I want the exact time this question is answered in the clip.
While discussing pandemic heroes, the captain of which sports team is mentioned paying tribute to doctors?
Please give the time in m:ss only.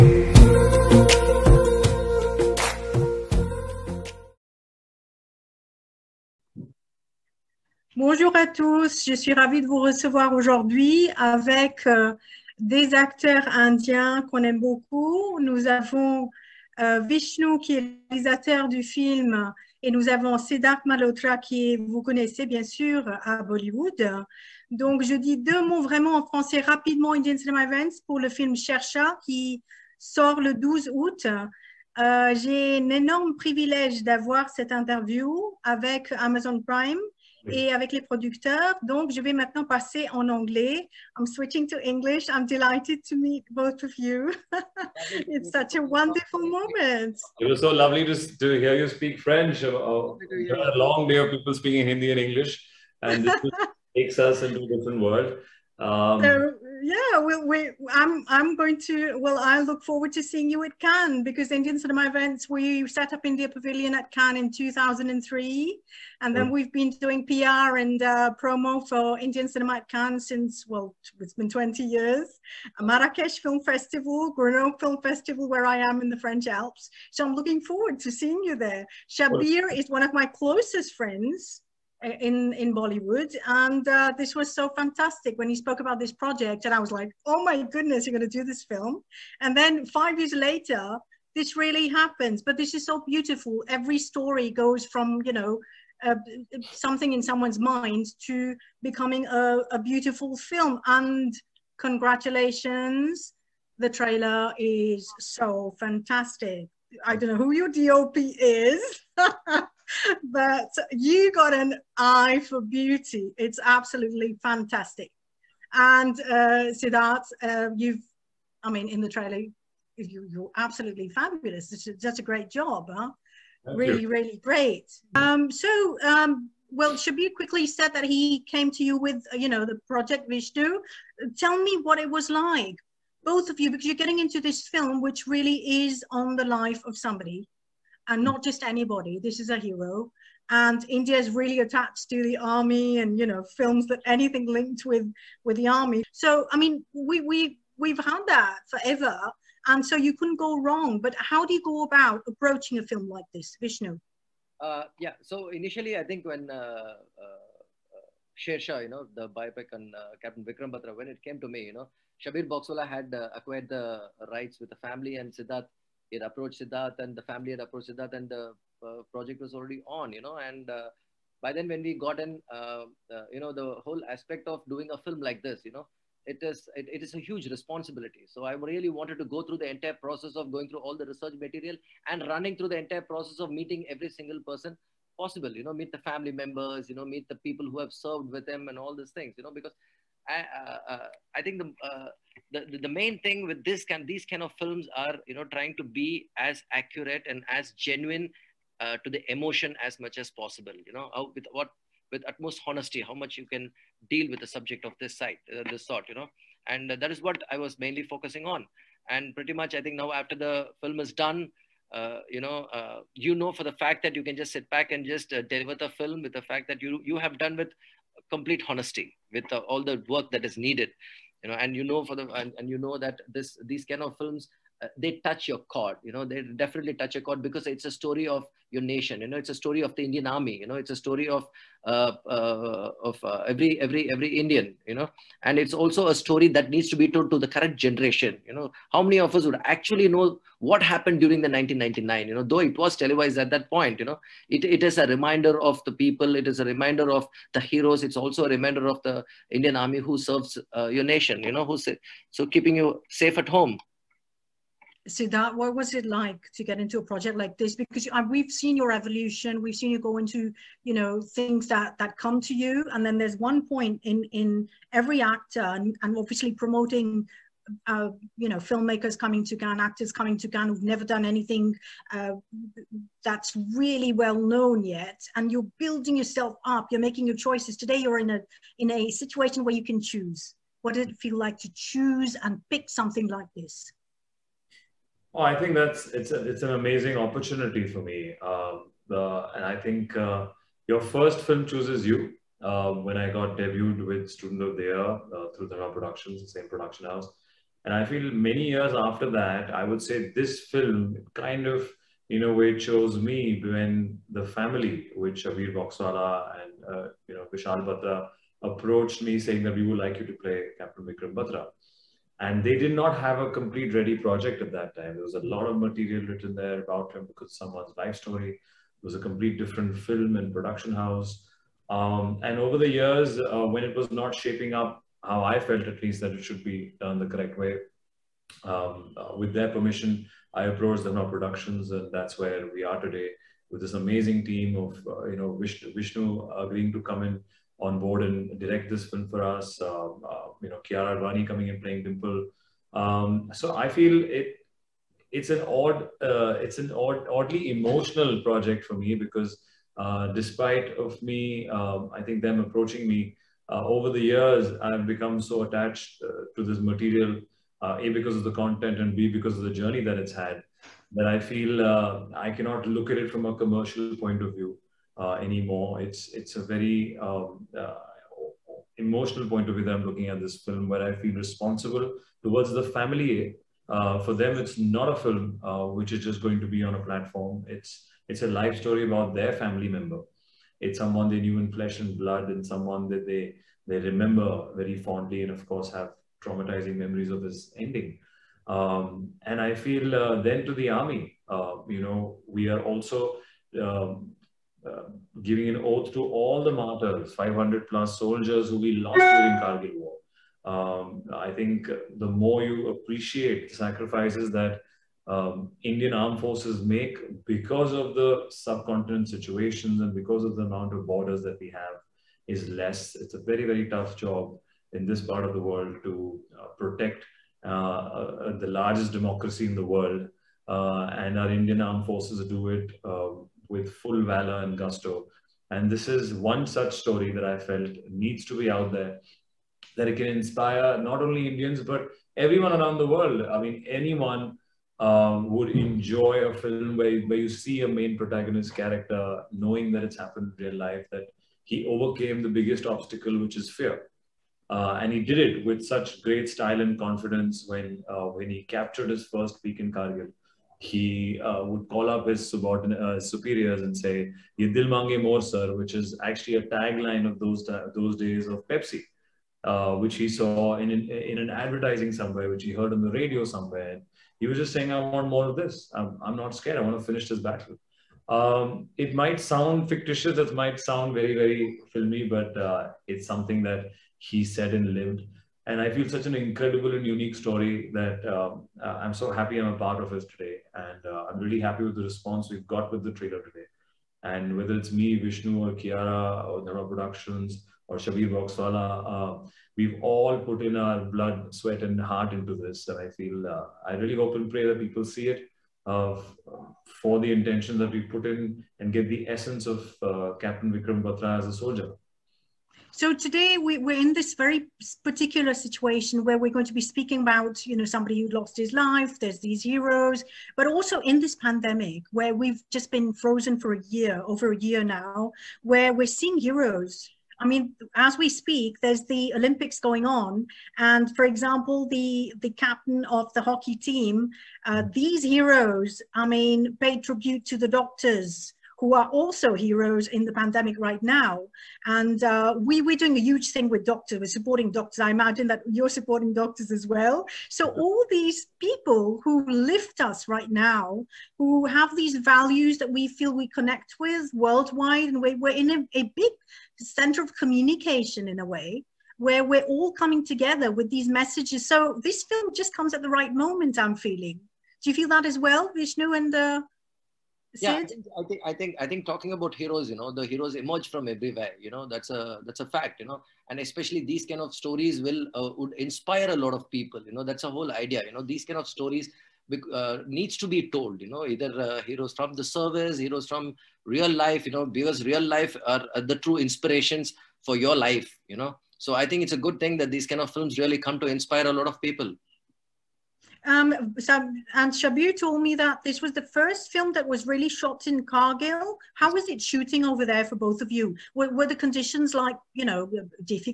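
8:43.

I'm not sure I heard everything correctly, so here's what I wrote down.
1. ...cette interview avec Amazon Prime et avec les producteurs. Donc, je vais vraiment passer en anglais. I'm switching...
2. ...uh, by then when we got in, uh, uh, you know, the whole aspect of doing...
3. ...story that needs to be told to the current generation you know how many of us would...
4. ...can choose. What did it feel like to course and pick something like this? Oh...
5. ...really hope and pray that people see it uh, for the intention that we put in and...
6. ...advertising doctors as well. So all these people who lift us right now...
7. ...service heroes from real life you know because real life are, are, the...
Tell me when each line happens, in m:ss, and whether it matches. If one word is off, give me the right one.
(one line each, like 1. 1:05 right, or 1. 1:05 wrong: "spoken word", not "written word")
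1. 0:34 wrong: "maintenant", not "vraiment"
2. 2:50 right
3. 3:56 right
4. 4:39 wrong: "choose", not "course"
5. 8:13 right
6. 8:55 wrong: "supporting", not "advertising"
7. 9:32 right.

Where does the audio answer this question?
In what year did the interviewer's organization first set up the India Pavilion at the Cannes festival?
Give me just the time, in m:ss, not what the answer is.
1:04.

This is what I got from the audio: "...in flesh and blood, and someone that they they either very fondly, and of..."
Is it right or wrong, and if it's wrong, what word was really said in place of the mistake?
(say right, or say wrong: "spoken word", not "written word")
wrong: "remember", not "either".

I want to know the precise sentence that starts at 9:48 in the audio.
How was it shooting over there for both of you?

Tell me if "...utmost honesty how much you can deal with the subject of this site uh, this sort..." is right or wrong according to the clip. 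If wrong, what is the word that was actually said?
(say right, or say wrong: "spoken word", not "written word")
right.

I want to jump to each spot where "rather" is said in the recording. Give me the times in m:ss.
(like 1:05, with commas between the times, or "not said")
not said.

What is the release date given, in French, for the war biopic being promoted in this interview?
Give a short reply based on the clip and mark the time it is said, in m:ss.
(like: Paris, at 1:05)
12 August, at 0:30.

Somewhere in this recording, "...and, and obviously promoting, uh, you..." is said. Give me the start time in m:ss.
4:25.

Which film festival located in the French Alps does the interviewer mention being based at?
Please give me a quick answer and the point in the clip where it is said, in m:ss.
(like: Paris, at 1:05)
Grenoble Film Festival, at 1:14.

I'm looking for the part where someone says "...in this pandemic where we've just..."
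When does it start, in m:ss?
8:31.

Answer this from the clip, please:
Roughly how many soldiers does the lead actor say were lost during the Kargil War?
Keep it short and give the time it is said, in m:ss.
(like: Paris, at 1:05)
500 plus, at 6:37.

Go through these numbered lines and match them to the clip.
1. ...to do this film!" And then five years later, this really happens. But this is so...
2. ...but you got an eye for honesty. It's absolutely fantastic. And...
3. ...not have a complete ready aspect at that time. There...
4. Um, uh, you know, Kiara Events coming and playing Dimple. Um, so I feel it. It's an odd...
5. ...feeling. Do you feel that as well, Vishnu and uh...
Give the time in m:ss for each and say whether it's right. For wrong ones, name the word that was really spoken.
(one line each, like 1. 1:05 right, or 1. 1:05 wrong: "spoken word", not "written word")
1. 1:28 right
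2. 1:50 wrong: "beauty", not "honesty"
3. 5:12 wrong: "project", not "aspect"
4. 5:39 wrong: "Advani", not "Events"
5. 9:13 right.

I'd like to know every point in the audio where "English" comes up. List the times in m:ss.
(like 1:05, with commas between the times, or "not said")
0:41, 0:52.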